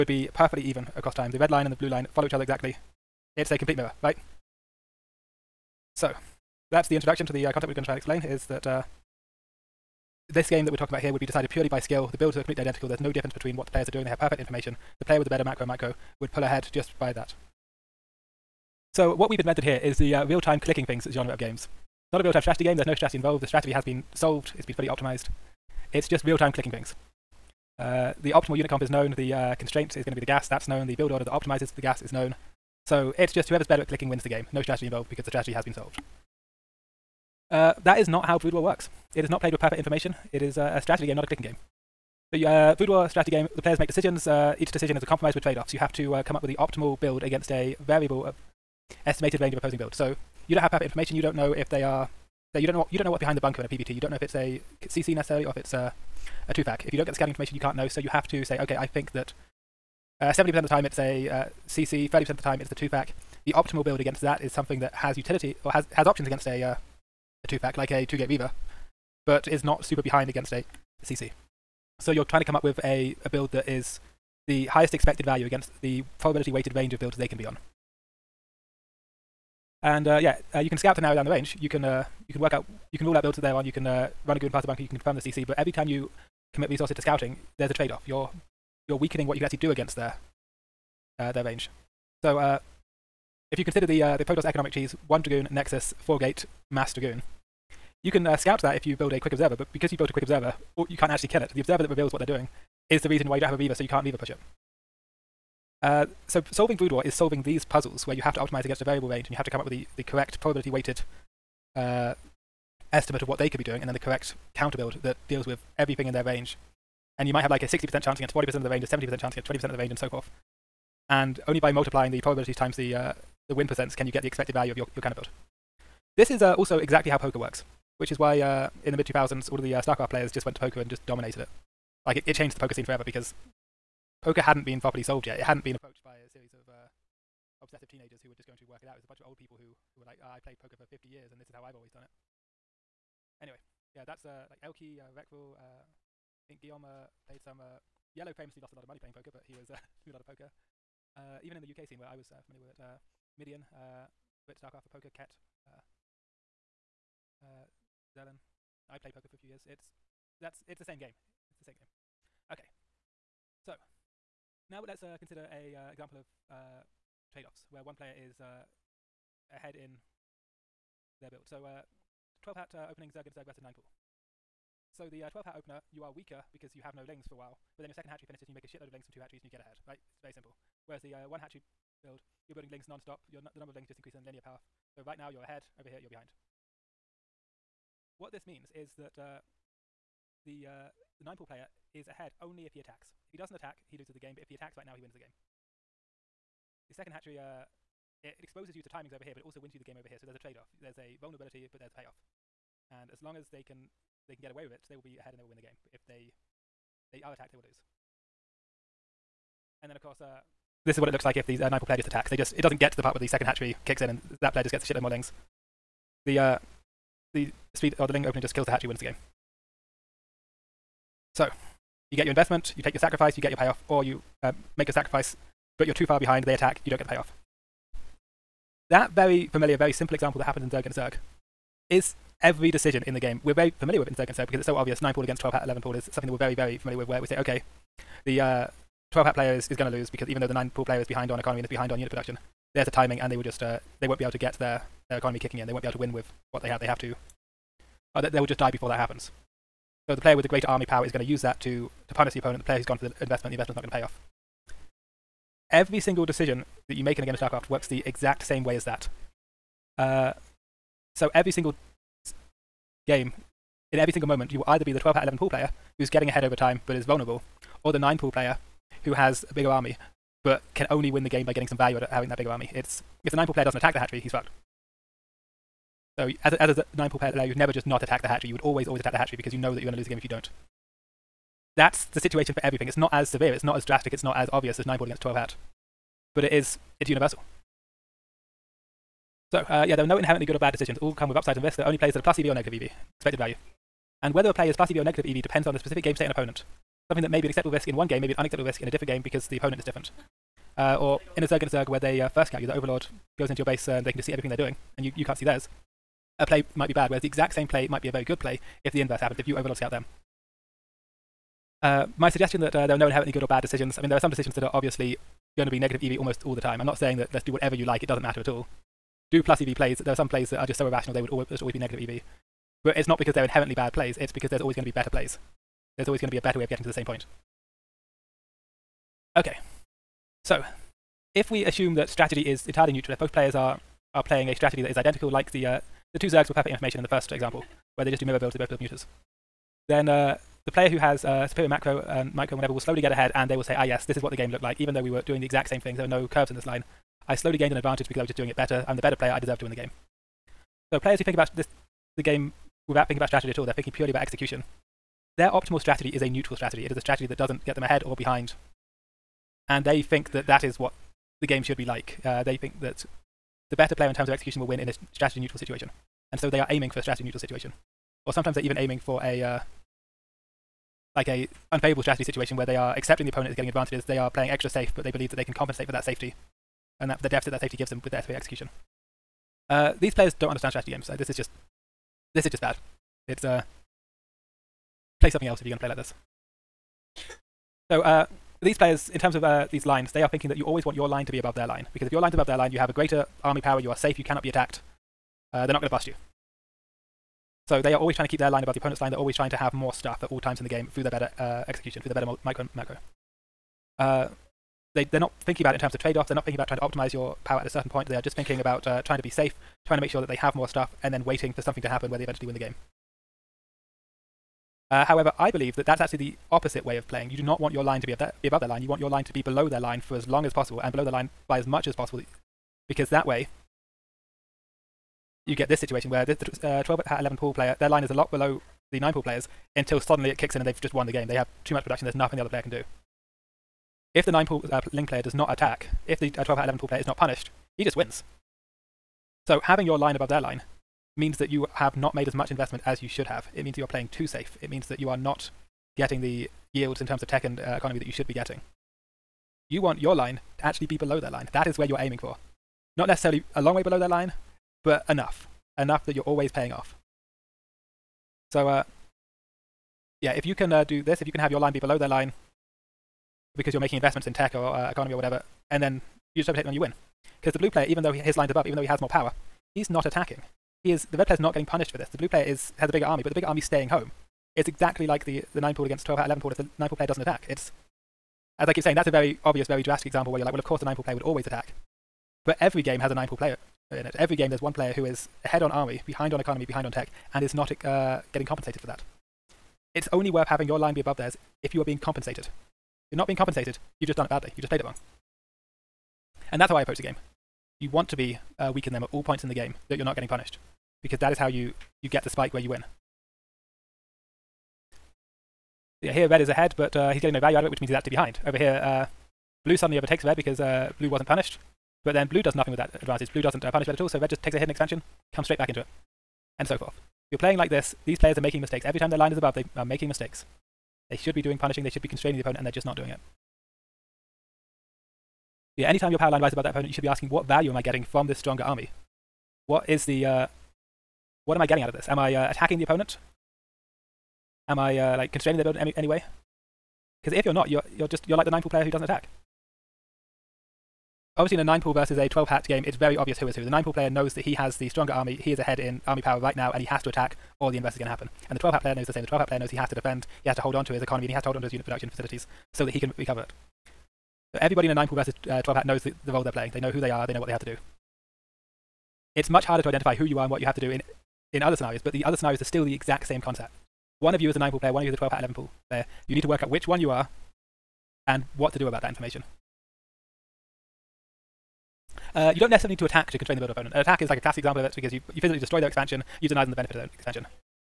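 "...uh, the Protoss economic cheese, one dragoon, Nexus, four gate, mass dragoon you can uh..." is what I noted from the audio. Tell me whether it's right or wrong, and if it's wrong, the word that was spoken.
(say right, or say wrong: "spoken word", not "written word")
right.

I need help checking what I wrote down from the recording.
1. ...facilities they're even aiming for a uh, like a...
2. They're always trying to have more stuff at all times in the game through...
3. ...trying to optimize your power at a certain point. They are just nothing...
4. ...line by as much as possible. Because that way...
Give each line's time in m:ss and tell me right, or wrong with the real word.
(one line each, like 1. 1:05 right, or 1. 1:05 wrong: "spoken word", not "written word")
1. 6:08 wrong: "sometimes", not "facilities"
2. 6:39 right
3. 6:46 wrong: "thinking", not "nothing"
4. 7:01 right.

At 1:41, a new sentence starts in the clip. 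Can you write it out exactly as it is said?
The observer that reveals what they're doing is the reason why you don't have a reaver, so you can't reaver push it.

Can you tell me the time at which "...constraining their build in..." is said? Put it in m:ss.
8:55.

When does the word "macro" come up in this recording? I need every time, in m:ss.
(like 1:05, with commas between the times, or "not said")
0:15, 5:41, 6:42.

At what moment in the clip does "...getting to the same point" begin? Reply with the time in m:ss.
5:26.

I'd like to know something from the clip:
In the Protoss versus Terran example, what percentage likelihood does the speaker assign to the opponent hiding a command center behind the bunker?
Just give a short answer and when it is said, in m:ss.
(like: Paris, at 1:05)
70%, at 1:00.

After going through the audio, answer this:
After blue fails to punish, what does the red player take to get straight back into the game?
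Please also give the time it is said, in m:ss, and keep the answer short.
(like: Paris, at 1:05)
a hidden expansion, at 8:34.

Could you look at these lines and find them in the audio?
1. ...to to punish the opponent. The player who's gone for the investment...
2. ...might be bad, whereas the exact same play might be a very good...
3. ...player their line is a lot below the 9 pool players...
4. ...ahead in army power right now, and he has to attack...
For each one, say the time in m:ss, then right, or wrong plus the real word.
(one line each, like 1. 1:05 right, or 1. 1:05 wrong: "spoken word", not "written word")
1. 4:11 right
2. 5:06 right
3. 7:07 right
4. 9:05 right.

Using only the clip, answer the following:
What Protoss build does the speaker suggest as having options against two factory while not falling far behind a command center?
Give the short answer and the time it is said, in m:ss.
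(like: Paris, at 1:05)
two gate reaver, at 1:08.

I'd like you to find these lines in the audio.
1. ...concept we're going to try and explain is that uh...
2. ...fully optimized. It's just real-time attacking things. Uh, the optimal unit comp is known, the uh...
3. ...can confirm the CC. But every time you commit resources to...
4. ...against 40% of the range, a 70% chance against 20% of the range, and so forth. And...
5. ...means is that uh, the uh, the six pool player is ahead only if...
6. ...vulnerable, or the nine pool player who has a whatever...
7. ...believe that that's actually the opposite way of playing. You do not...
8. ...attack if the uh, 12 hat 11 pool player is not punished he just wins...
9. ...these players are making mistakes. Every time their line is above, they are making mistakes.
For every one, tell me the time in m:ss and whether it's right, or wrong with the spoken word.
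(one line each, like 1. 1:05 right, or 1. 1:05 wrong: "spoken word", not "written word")
1. 0:07 right
2. 0:24 wrong: "clicking", not "attacking"
3. 1:24 right
4. 1:58 right
5. 3:08 wrong: "nine", not "six"
6. 4:27 wrong: "bigger", not "whatever"
7. 6:55 right
8. 7:15 right
9. 8:38 right.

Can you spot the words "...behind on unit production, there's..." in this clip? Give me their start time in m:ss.
4:01.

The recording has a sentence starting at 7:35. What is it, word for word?
Enough that you're always paying off.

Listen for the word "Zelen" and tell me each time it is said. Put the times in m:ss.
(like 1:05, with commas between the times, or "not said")
2:38.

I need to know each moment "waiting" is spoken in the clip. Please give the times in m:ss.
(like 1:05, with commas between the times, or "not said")
6:51.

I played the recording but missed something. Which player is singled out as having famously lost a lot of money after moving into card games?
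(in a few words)
Yellow.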